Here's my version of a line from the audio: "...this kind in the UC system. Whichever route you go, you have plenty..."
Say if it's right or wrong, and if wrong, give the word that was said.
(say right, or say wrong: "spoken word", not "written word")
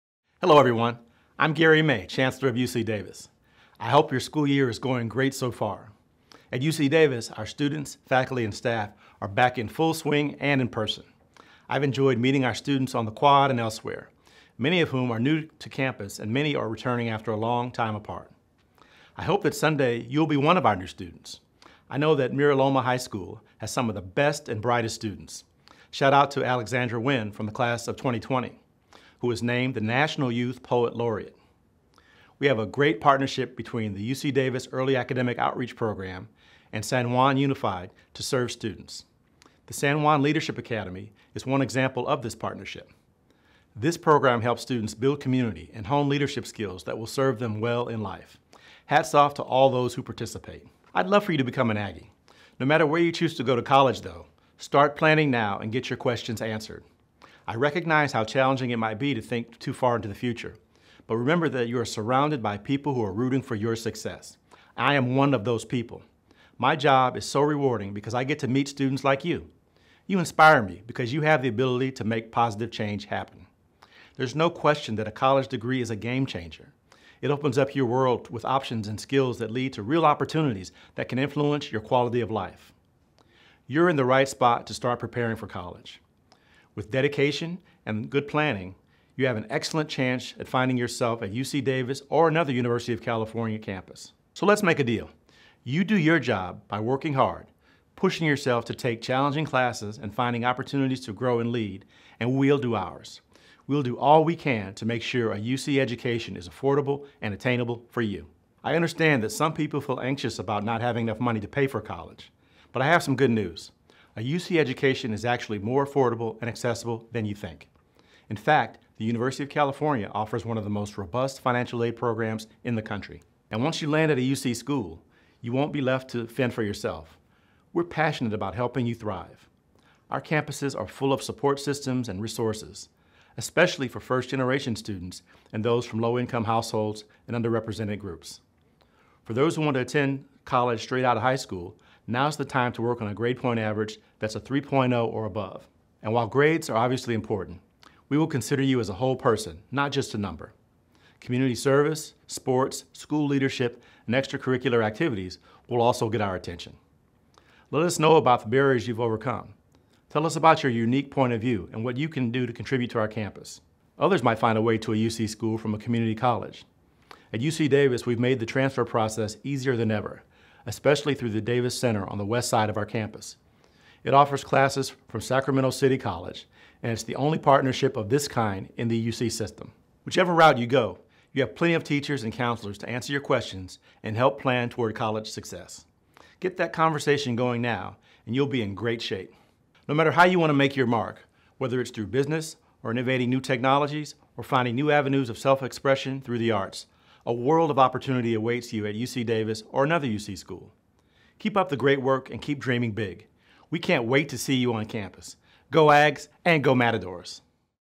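right.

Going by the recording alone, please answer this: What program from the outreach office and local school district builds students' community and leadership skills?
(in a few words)
San Juan Leadership Academy.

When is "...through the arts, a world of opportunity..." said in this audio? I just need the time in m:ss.
3:16.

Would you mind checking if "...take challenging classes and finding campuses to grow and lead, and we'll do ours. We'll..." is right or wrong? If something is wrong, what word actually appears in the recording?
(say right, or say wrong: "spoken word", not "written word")
wrong: "opportunities", not "campuses".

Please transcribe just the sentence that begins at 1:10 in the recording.
You inspire me because you have the ability to make positive change happen.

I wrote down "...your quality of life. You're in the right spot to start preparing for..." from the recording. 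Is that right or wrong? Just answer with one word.
right.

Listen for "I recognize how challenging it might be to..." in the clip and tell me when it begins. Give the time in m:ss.
0:57.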